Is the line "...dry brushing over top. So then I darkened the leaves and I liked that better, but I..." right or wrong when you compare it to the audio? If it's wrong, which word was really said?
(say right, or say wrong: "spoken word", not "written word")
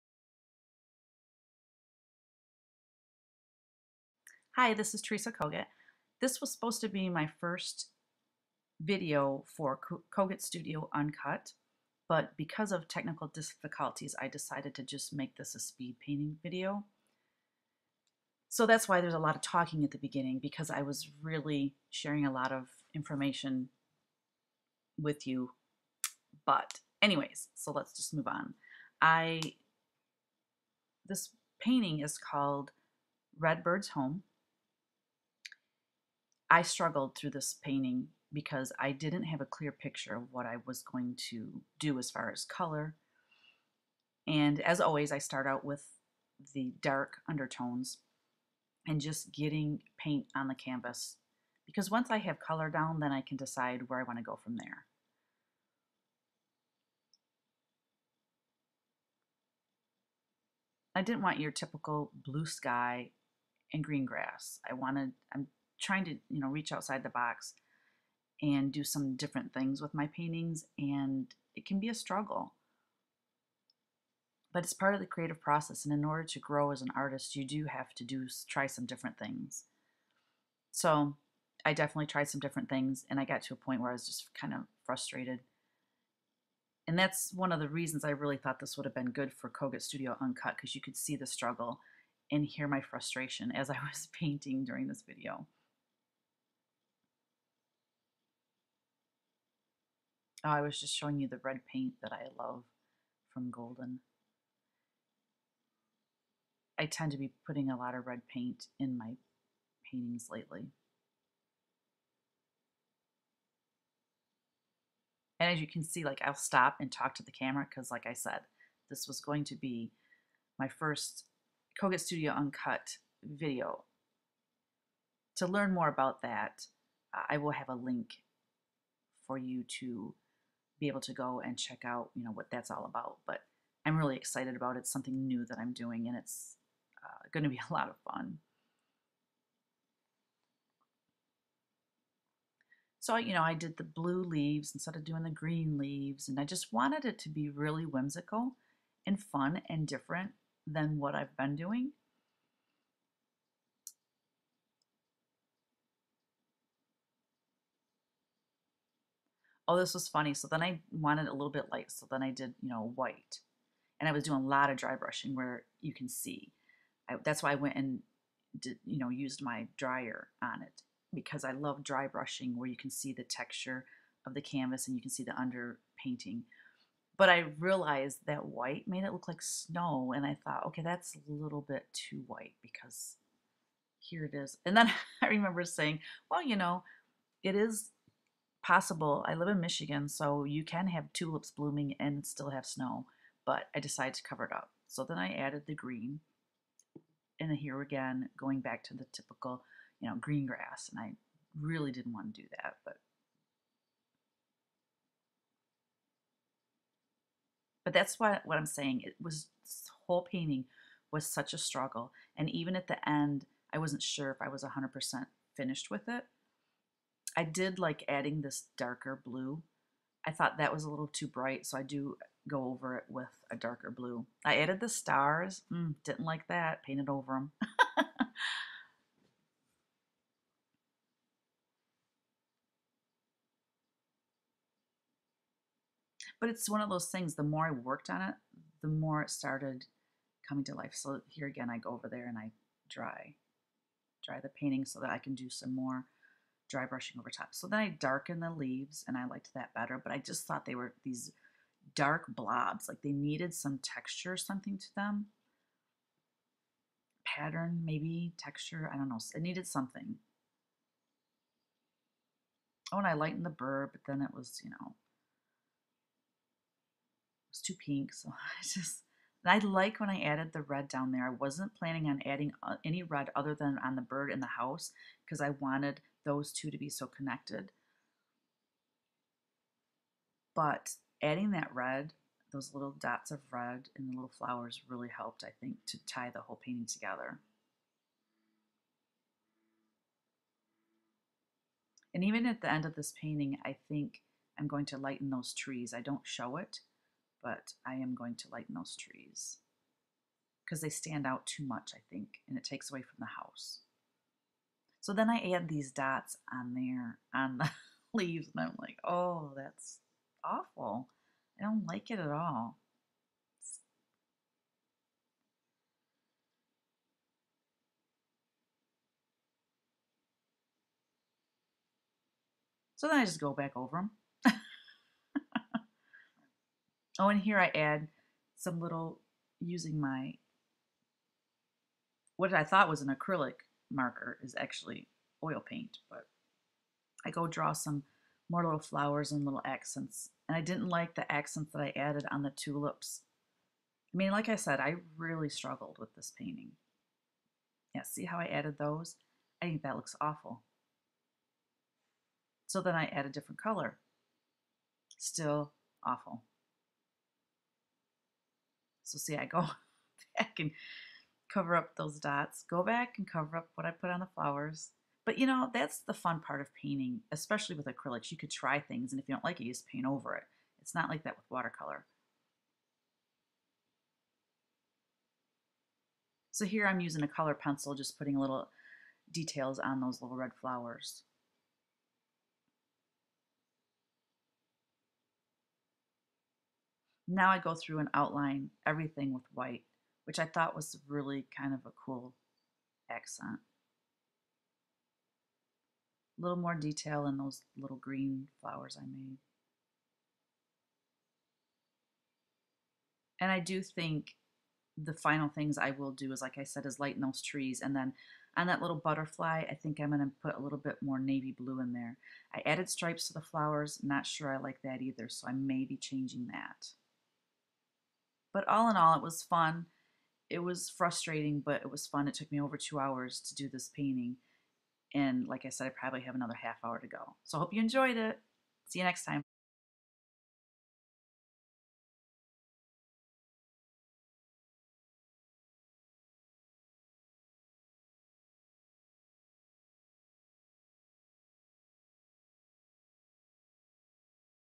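right.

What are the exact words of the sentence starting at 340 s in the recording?
And I didn't like the accents that I added on the tulips.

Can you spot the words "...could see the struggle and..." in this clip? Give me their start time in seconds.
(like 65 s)
90 s.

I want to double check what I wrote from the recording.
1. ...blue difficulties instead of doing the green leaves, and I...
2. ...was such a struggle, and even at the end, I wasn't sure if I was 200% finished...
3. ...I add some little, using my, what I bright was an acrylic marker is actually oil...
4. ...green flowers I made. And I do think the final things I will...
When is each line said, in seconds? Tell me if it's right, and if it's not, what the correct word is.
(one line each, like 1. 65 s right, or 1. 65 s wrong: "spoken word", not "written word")
1. 143 s wrong: "leaves", not "difficulties"
2. 211 s wrong: "100", not "200"
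3. 327 s wrong: "thought", not "bright"
4. 397 s right.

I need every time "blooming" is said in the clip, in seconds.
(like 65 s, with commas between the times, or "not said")
191 s.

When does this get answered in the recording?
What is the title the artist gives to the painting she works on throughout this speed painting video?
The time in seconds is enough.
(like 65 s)
33 s.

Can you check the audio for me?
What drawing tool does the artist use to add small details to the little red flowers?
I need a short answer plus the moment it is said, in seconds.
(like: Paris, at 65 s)
Color pencil, at 377 s.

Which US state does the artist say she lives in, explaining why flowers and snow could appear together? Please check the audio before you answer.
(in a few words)
Michigan.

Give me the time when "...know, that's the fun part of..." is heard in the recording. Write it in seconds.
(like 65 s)
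365 s.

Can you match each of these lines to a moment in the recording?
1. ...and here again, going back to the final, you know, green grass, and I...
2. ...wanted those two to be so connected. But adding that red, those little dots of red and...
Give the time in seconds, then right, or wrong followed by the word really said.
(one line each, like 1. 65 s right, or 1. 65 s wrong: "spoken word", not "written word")
1. 197 s wrong: "typical", not "final"
2. 275 s right.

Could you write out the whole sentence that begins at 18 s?
So that's why there's a lot of talking at the beginning because I was really sharing a lot of information with you.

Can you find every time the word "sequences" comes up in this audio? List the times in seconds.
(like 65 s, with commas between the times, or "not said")
not said.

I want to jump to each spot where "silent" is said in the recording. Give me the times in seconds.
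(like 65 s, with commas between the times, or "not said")
not said.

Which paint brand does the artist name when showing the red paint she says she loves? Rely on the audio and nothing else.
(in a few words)
Golden.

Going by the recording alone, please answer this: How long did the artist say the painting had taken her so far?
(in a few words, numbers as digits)
Over 2 hours.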